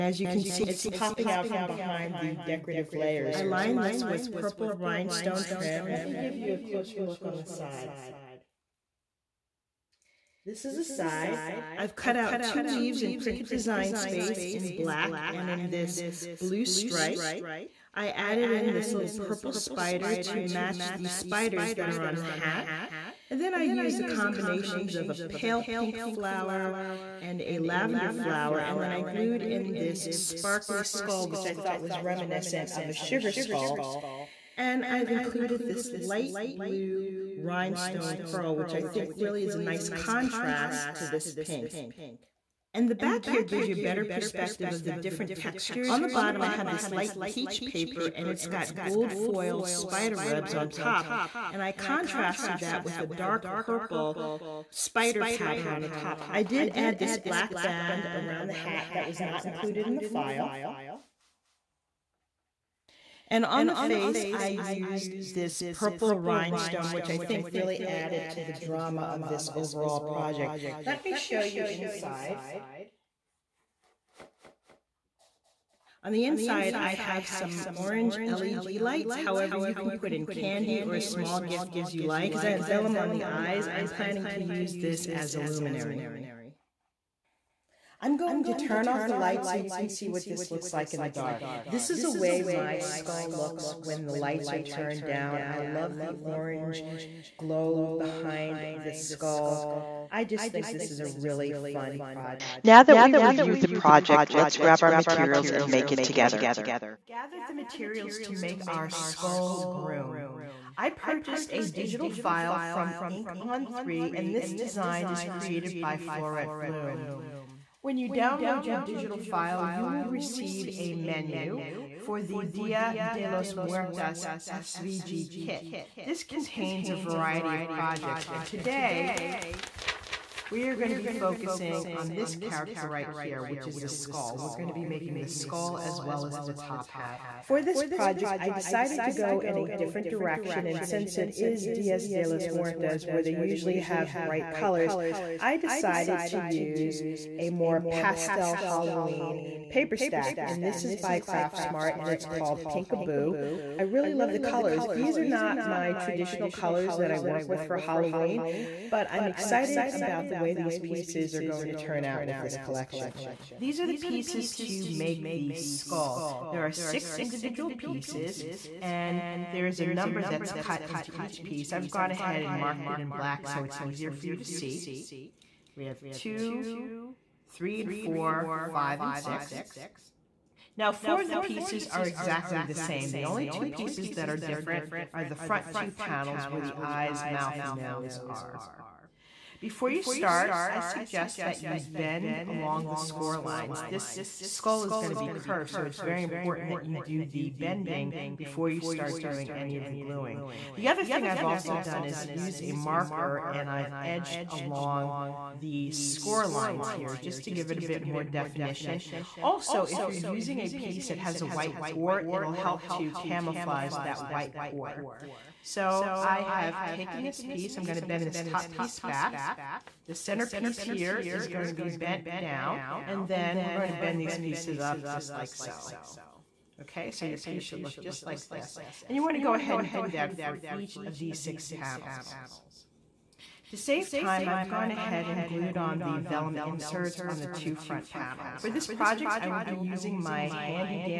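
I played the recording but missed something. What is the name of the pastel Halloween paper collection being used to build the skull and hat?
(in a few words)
Pinkaboo.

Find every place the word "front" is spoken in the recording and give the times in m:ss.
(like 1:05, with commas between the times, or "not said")
3:05, 3:57.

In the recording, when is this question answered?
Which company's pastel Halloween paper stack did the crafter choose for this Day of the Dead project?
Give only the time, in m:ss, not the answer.
2:31.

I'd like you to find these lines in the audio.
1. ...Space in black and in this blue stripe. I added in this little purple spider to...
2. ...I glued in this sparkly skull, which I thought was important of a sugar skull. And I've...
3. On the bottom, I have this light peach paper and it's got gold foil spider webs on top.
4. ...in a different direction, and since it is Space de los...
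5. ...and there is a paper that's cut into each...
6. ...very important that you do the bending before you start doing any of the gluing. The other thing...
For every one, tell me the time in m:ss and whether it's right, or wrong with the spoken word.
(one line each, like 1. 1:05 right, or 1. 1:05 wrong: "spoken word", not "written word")
1. 0:13 right
2. 0:28 wrong: "reminiscent", not "important"
3. 0:45 right
4. 2:19 wrong: "Dias", not "Space"
5. 2:48 wrong: "number", not "paper"
6. 3:15 right.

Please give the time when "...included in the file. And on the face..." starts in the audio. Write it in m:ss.
0:59.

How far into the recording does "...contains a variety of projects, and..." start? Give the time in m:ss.
2:06.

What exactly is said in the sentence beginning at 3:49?
And you want to go ahead and do that for each of these six panels.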